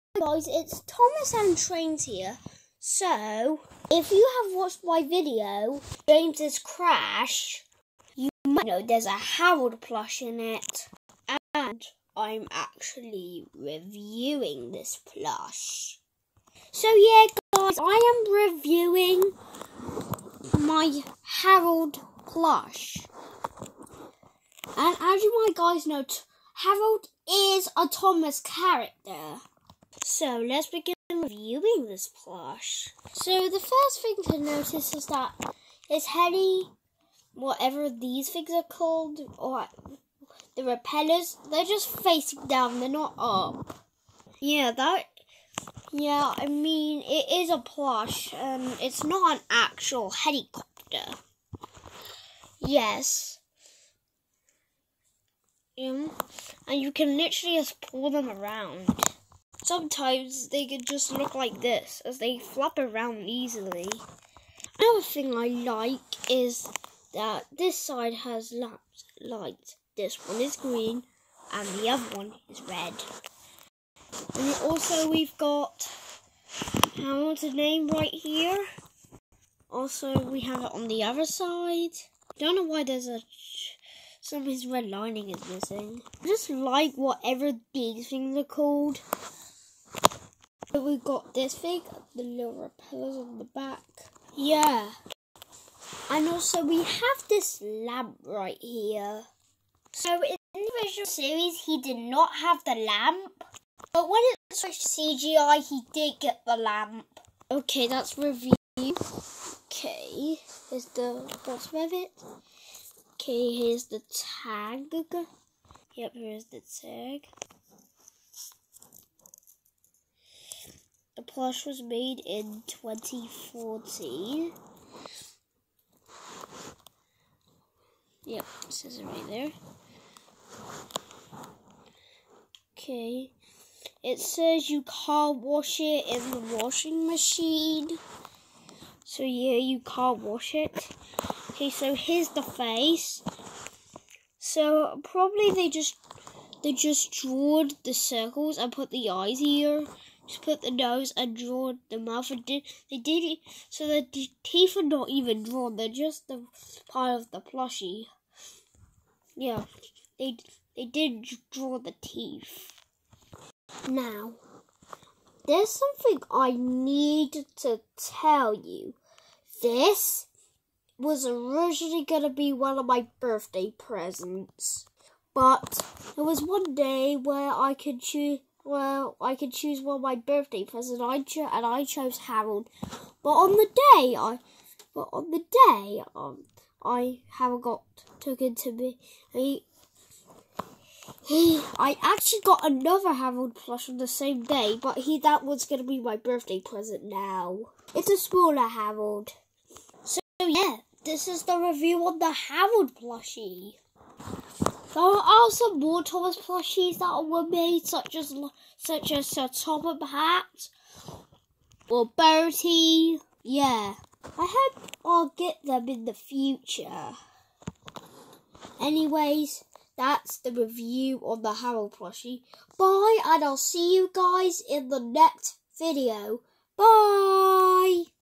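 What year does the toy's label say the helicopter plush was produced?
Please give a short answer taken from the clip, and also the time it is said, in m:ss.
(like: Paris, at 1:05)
2014, at 2:01.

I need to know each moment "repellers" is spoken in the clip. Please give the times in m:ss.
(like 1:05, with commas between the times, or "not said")
0:40, 1:32.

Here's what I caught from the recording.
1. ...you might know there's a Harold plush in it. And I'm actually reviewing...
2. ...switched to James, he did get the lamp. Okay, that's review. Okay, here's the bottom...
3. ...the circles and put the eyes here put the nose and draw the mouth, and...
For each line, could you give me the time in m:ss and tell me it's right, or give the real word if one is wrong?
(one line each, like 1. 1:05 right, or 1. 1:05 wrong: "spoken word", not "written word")
1. 0:08 right
2. 1:44 wrong: "CGI", not "James"
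3. 2:27 right.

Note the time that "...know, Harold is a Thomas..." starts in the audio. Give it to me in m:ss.
0:25.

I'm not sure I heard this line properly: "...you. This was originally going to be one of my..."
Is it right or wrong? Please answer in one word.
right.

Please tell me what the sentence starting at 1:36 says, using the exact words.
And also we have this lamp right here.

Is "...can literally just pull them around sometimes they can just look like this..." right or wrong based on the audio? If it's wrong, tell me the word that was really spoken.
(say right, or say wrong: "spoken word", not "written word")
right.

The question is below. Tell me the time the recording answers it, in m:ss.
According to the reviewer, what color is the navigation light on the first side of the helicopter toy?
1:09.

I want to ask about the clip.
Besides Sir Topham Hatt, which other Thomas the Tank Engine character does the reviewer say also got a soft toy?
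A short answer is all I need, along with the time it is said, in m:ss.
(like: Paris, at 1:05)
Bertie, at 3:32.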